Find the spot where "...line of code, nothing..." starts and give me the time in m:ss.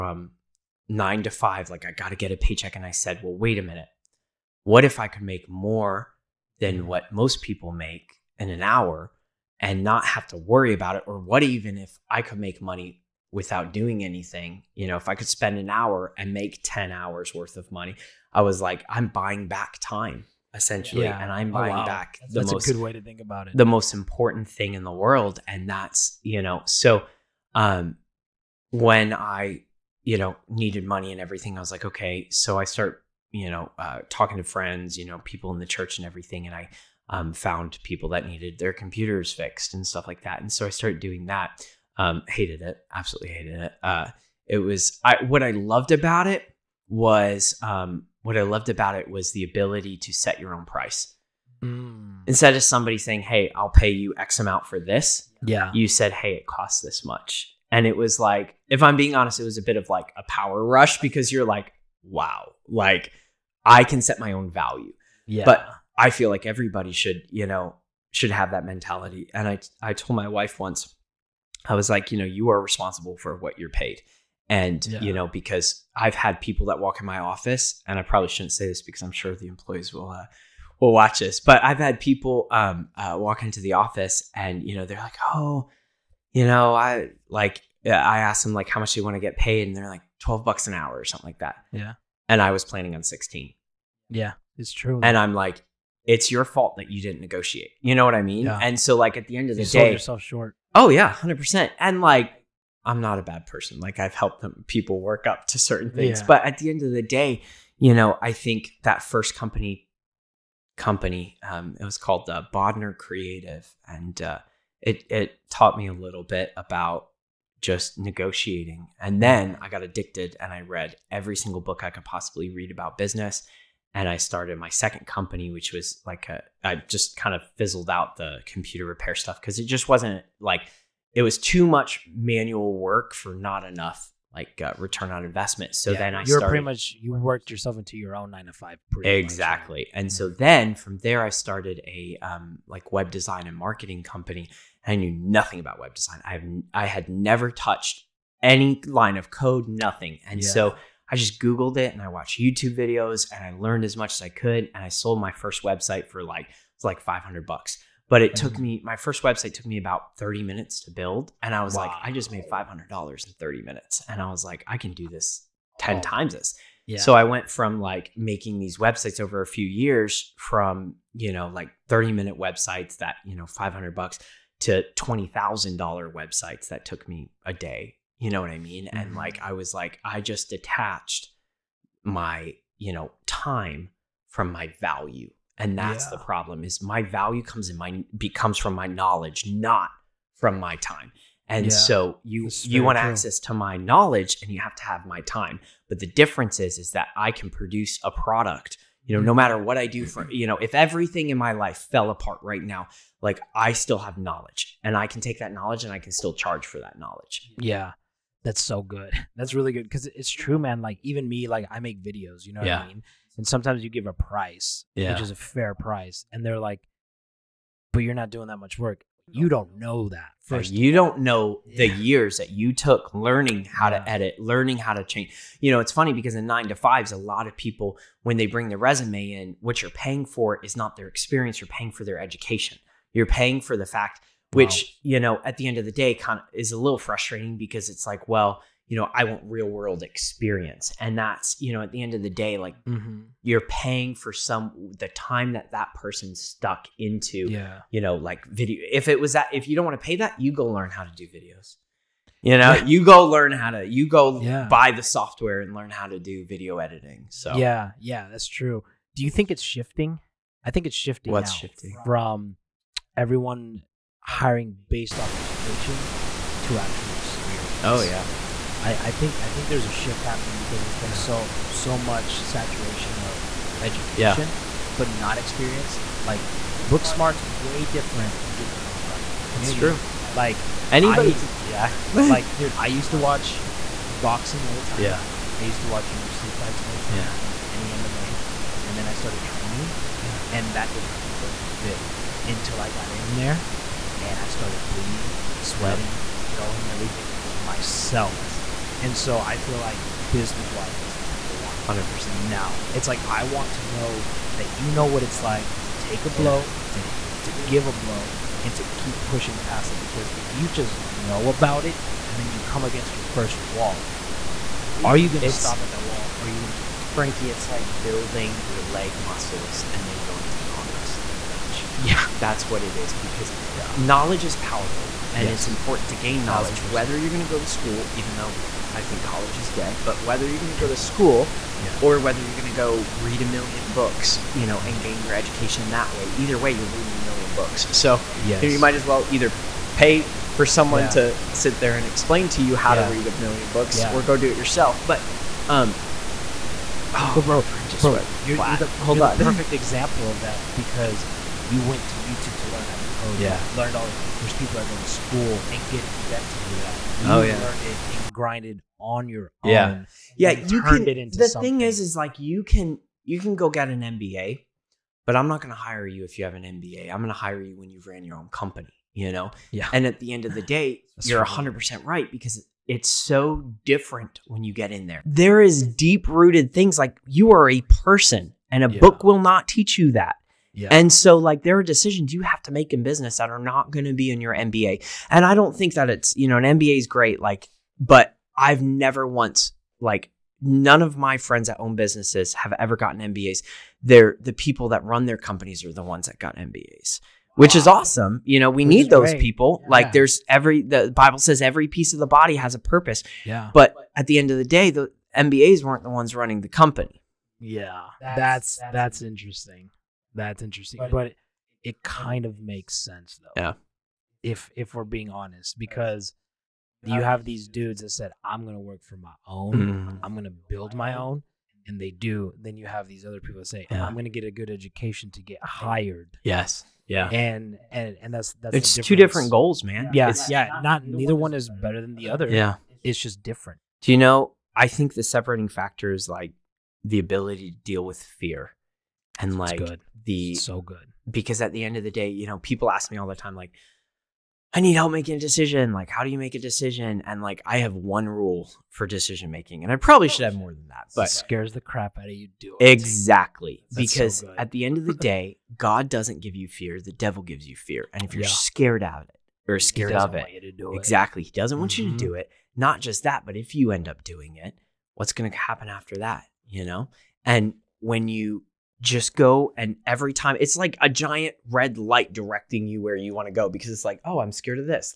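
2:28.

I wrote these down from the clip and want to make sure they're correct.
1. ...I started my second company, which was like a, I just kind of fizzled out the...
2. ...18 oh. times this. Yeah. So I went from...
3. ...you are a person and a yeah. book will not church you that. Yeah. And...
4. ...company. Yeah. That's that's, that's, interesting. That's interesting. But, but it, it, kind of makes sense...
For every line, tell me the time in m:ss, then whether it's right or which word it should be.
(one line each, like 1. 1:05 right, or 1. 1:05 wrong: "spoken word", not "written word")
1. 2:04 right
2. 2:45 wrong: "10", not "18"
3. 6:17 wrong: "teach", not "church"
4. 6:46 right.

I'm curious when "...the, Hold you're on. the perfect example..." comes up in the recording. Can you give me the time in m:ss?
5:48.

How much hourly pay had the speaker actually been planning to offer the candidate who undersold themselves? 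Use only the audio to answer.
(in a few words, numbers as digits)
$16.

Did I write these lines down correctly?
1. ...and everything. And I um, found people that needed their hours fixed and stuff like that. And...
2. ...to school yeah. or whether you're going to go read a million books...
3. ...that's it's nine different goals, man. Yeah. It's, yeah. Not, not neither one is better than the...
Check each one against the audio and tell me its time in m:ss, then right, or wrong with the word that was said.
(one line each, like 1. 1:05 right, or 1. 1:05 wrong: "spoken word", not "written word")
1. 0:35 wrong: "computers", not "hours"
2. 5:30 right
3. 7:08 wrong: "two", not "nine".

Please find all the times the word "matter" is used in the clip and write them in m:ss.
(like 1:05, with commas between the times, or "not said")
3:19, 4:51.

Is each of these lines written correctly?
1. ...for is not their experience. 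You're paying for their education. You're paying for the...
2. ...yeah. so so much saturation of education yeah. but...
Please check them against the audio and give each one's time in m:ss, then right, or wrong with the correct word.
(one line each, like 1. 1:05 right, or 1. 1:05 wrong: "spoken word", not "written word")
1. 3:50 right
2. 4:31 right.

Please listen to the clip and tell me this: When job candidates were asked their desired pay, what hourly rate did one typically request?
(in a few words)
$12.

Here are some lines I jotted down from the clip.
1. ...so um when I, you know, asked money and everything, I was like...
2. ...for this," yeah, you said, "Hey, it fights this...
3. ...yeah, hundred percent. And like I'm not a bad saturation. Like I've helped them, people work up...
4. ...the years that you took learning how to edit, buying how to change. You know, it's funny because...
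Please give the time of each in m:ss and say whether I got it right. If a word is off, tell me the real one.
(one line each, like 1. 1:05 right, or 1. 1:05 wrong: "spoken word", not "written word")
1. 0:26 wrong: "needed", not "asked"
2. 0:54 wrong: "costs", not "fights"
3. 1:40 wrong: "person", not "saturation"
4. 3:41 wrong: "learning", not "buying".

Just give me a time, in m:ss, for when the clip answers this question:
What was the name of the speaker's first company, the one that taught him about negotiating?
1:52.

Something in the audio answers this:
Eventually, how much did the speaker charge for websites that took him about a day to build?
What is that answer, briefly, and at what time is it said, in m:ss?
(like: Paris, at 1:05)
$20,000, at 2:54.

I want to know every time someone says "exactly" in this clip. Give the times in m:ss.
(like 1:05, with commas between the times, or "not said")
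2:19, 7:32, 7:40.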